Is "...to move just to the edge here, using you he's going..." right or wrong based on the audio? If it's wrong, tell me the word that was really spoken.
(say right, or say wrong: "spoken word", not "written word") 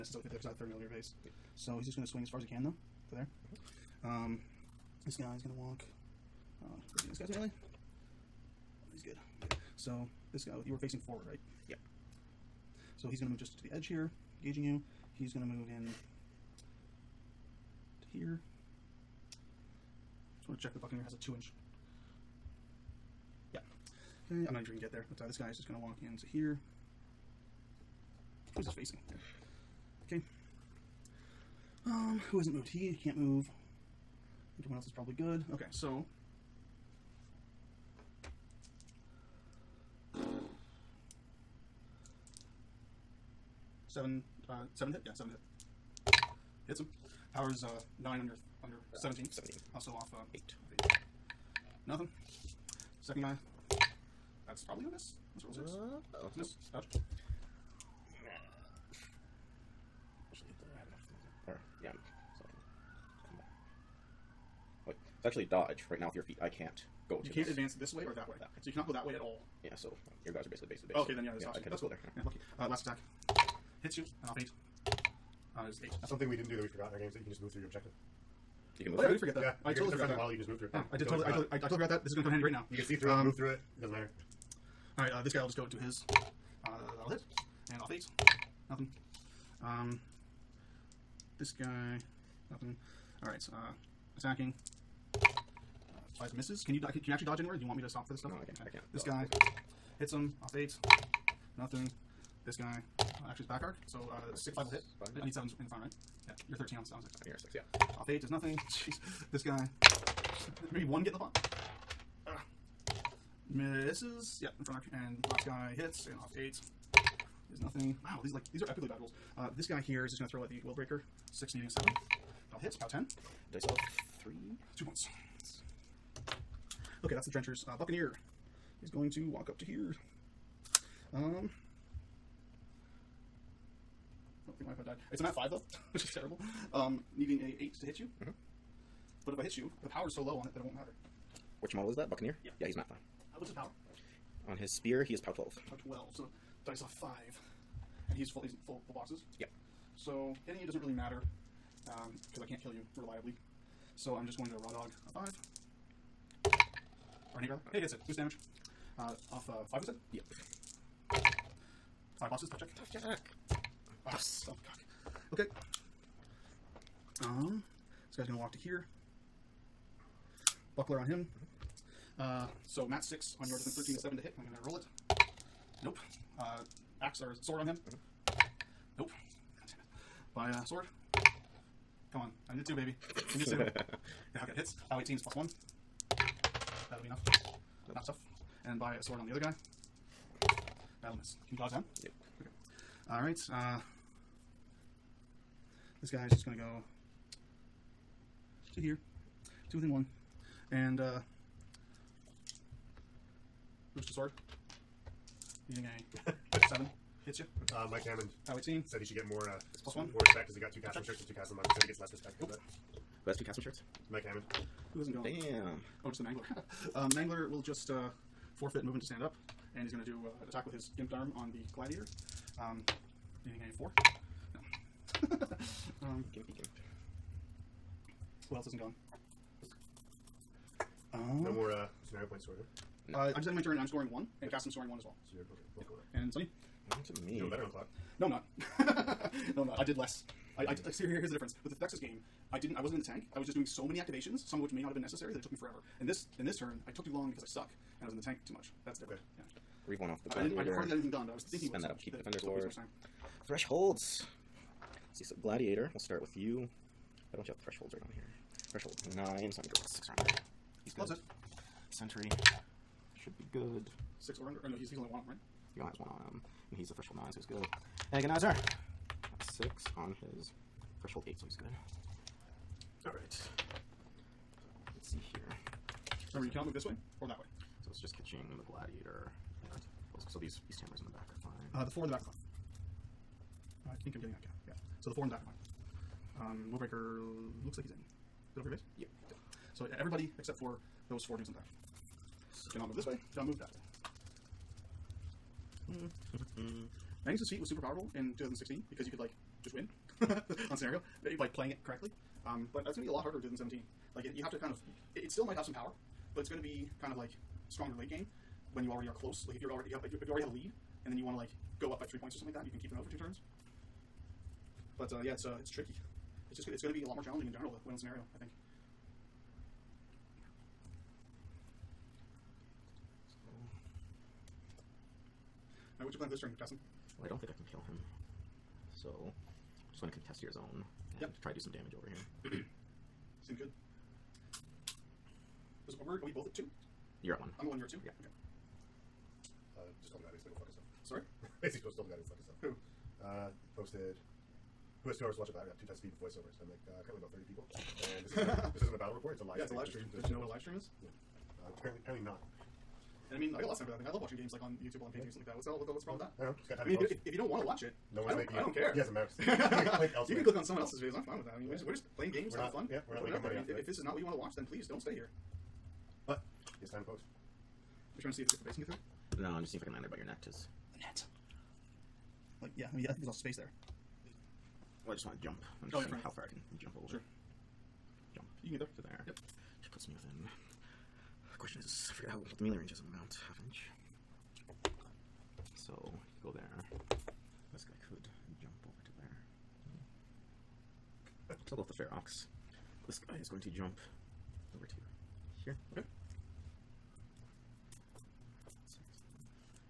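wrong: "gauging", not "using".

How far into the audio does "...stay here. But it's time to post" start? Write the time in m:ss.
6:04.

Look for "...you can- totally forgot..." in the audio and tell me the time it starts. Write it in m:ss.
1:19.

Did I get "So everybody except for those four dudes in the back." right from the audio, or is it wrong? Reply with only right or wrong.
right.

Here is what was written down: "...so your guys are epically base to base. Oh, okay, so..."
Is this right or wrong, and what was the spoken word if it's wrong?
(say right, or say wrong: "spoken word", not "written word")
wrong: "basically", not "epically".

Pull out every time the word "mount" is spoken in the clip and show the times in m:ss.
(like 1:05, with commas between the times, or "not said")
6:23.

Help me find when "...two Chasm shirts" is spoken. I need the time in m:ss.
3:33.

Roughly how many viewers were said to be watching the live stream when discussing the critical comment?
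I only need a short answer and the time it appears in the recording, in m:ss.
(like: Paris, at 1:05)
30, at 5:47.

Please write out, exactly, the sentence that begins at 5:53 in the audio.
And I mean, I got lots of time for that thing.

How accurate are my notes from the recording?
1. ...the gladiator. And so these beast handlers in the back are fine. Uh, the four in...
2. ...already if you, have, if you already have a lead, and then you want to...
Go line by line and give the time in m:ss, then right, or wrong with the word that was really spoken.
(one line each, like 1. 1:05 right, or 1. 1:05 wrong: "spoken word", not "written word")
1. 4:38 right
2. 5:09 right.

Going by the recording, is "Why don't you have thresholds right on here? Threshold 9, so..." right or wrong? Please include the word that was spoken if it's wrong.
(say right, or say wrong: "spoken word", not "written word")
right.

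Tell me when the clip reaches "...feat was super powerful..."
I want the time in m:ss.
4:57.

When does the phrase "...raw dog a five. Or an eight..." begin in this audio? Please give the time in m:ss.
2:34.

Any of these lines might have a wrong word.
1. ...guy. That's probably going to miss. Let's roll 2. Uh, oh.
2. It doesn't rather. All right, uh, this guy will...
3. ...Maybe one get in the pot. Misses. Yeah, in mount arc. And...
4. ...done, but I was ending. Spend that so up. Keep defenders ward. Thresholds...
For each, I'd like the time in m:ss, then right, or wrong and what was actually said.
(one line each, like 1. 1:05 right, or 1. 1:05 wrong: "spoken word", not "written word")
1. 0:53 wrong: "6", not "2"
2. 1:23 wrong: "matter", not "rather"
3. 1:50 wrong: "front", not "mount"
4. 4:11 wrong: "thinking", not "ending".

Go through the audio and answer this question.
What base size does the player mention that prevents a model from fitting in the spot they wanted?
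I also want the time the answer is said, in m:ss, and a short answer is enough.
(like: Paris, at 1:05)
30mm, at 0:00.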